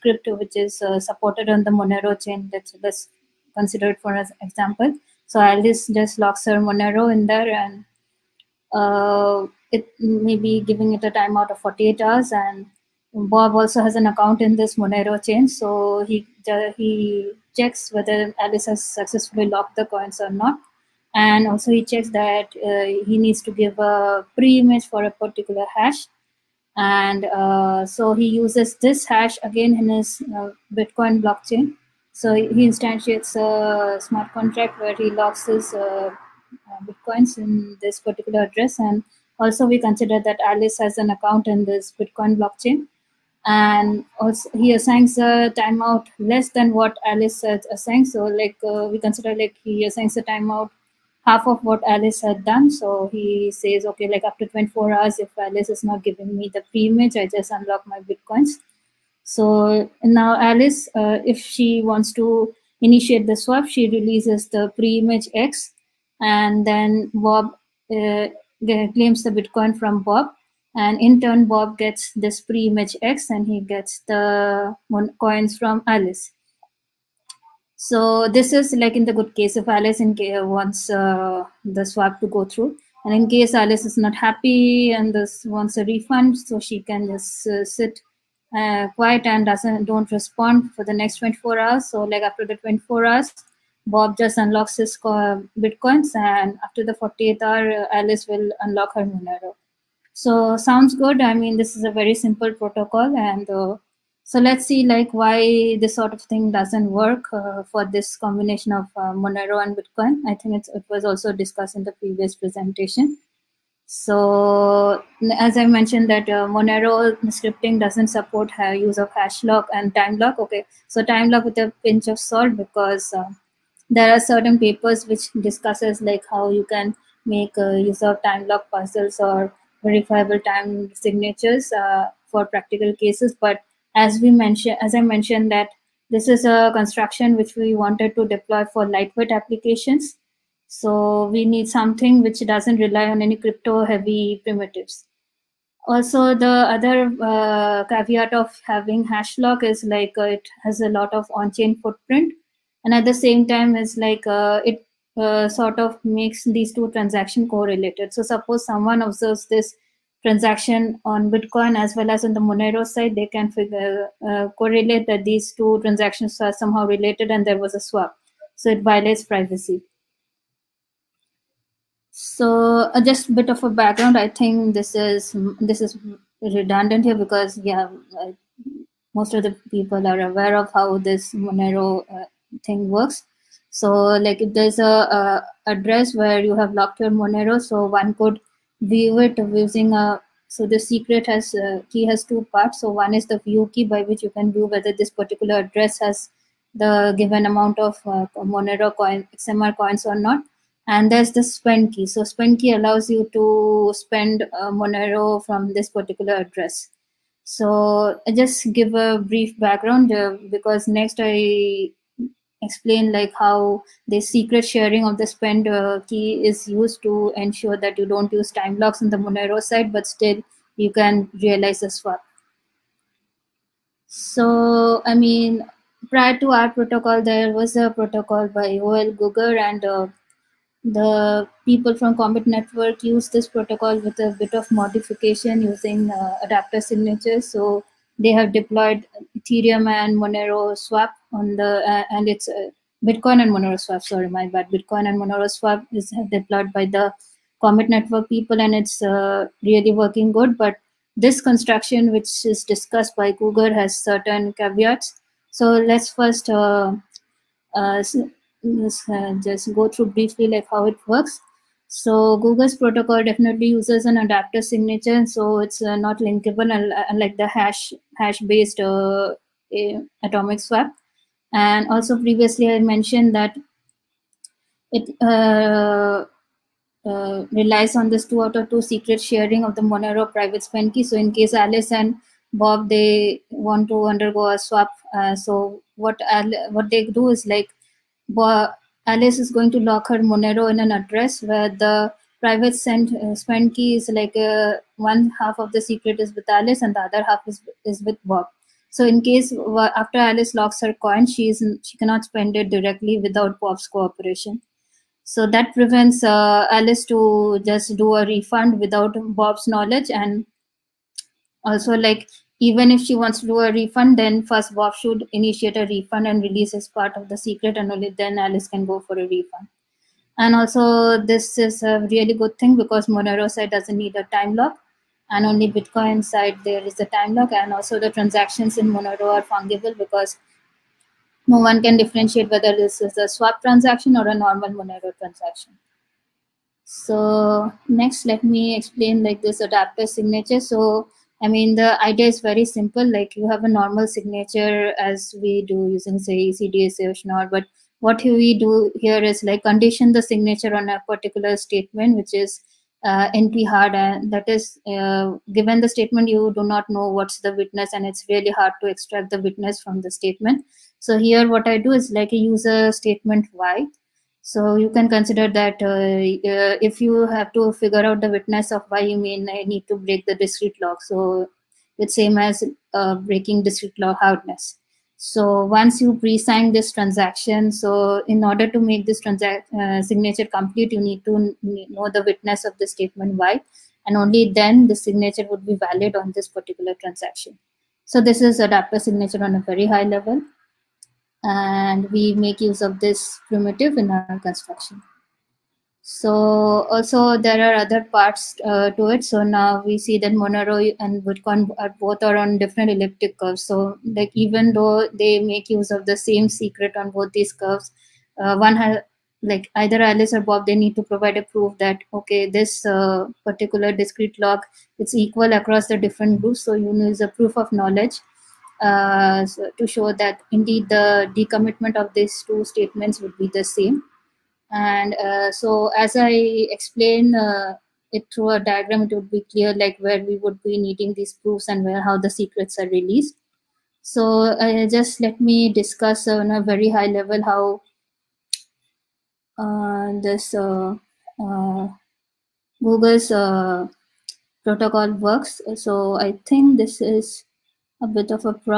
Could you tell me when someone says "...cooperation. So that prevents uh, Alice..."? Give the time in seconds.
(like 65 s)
303 s.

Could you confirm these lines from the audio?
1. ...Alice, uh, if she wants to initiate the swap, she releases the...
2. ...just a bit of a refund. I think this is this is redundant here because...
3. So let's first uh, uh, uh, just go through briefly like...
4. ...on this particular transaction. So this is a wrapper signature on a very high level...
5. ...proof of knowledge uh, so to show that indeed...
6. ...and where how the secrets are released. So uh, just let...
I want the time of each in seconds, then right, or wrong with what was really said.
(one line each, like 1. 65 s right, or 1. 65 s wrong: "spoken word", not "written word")
1. 60 s right
2. 173 s wrong: "background", not "refund"
3. 255 s right
4. 386 s right
5. 417 s right
6. 431 s right.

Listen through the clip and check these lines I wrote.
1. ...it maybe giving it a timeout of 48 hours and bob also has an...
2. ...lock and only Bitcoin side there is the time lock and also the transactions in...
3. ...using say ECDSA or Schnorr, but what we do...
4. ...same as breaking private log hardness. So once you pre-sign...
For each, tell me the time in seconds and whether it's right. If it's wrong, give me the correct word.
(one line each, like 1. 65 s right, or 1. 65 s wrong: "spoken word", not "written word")
1. 9 s right
2. 324 s right
3. 345 s right
4. 372 s wrong: "discrete", not "private".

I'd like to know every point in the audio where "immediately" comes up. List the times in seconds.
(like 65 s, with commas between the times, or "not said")
not said.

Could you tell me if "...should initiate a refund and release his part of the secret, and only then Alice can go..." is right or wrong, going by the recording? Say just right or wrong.
right.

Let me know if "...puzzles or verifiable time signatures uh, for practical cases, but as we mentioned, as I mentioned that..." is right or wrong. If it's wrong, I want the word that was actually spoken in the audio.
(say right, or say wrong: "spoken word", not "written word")
right.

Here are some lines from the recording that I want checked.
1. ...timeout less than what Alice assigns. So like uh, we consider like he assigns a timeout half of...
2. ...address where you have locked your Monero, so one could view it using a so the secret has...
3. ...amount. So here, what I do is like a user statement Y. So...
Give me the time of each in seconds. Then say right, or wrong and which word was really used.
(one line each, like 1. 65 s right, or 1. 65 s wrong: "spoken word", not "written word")
1. 45 s right
2. 185 s right
3. 360 s wrong: "statement", not "amount".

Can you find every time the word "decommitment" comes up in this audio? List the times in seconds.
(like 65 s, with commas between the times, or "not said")
421 s.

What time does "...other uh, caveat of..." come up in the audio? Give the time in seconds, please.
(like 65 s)
146 s.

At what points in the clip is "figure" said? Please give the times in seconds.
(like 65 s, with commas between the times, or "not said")
163 s, 367 s.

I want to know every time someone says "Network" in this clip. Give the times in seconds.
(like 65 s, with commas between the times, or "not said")
232 s, 247 s.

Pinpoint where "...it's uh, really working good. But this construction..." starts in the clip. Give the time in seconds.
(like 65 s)
248 s.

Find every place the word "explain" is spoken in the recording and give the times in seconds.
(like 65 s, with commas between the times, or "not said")
212 s, 338 s, 426 s.